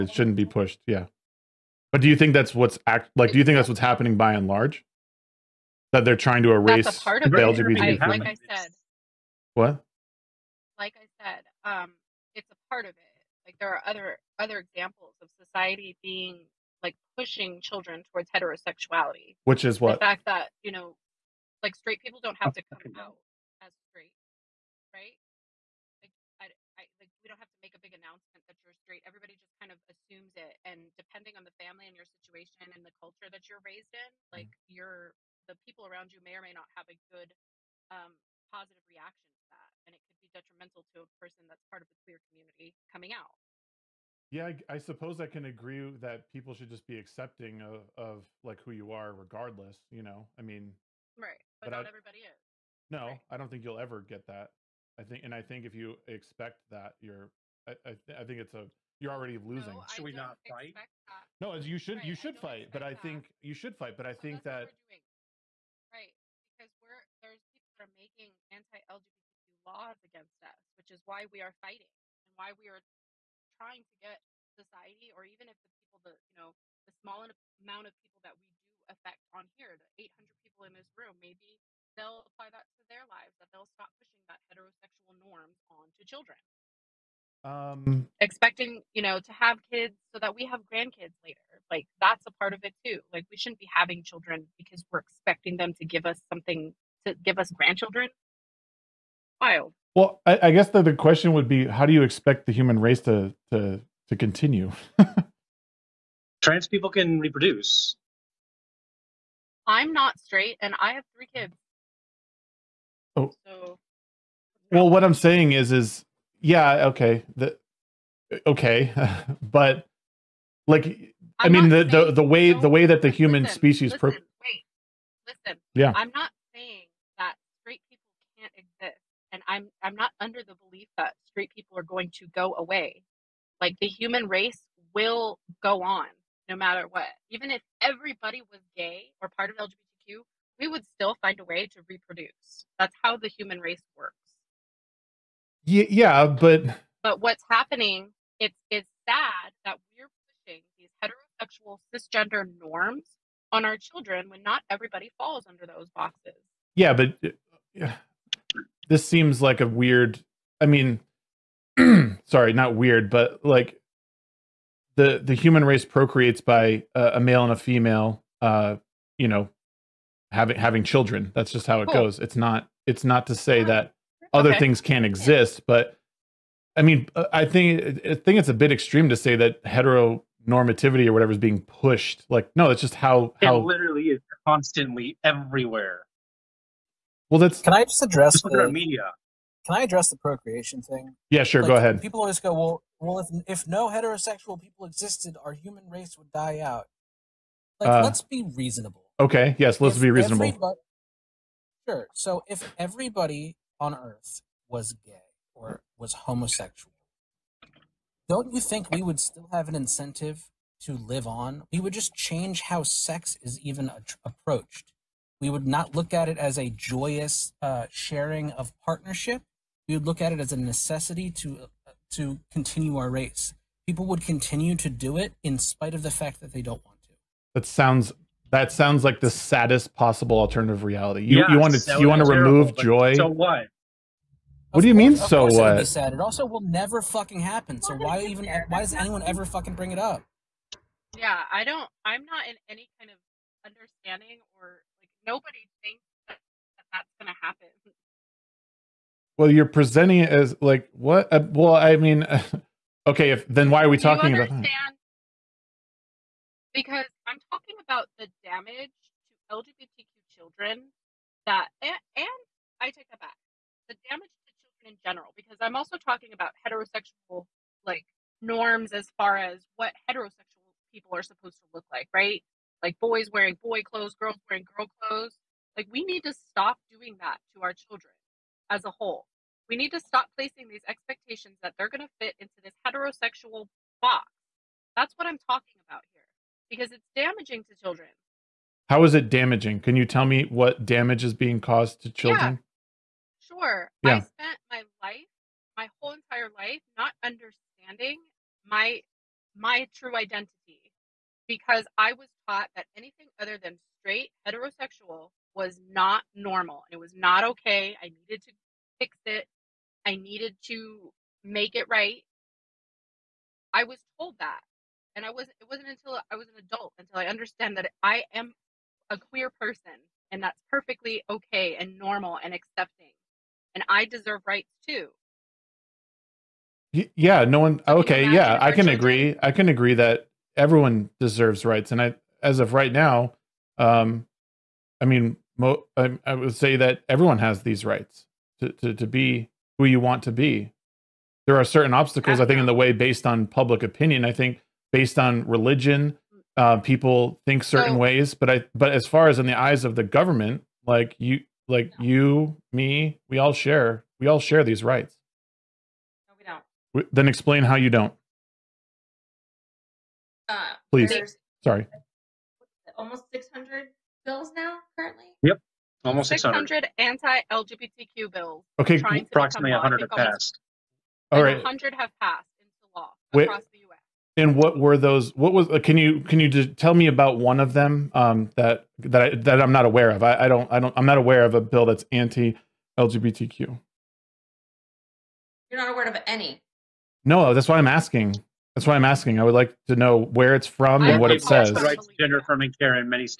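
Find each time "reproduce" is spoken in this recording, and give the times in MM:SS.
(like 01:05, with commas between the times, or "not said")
01:47, 02:21.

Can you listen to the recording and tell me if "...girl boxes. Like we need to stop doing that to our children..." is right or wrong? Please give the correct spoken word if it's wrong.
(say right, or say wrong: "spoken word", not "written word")
wrong: "clothes", not "boxes".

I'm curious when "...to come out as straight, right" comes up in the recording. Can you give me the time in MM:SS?
00:22.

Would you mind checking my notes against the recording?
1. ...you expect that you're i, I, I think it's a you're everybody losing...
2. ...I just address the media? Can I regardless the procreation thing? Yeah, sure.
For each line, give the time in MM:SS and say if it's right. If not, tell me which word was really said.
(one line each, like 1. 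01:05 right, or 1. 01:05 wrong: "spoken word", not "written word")
1. 00:55 wrong: "already", not "everybody"
2. 03:07 wrong: "address", not "regardless".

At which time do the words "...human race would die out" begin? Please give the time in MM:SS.
03:15.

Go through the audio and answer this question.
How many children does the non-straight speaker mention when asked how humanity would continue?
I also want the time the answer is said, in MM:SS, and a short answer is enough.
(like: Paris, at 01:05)
3, at 01:51.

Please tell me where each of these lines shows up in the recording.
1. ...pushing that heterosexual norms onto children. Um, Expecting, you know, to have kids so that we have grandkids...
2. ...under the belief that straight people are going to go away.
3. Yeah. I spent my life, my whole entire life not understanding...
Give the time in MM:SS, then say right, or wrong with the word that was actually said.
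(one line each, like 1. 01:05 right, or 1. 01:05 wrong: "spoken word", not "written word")
1. 01:23 right
2. 02:10 right
3. 04:54 right.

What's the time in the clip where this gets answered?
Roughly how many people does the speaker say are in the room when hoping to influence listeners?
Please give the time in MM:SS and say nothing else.
01:20.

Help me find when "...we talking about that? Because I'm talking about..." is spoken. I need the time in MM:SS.
04:13.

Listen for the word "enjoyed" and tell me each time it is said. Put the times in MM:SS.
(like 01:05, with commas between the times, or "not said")
not said.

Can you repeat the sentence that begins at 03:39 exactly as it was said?
We would look at it as a necessity to uh, to continue our race.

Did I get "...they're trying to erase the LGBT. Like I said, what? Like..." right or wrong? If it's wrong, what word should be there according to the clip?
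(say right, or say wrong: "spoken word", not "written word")
right.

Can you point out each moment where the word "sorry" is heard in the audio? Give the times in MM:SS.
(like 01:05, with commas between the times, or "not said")
02:42, 06:01.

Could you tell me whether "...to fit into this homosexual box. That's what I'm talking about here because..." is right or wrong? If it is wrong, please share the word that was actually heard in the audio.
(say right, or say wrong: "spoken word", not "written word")
wrong: "heterosexual", not "homosexual".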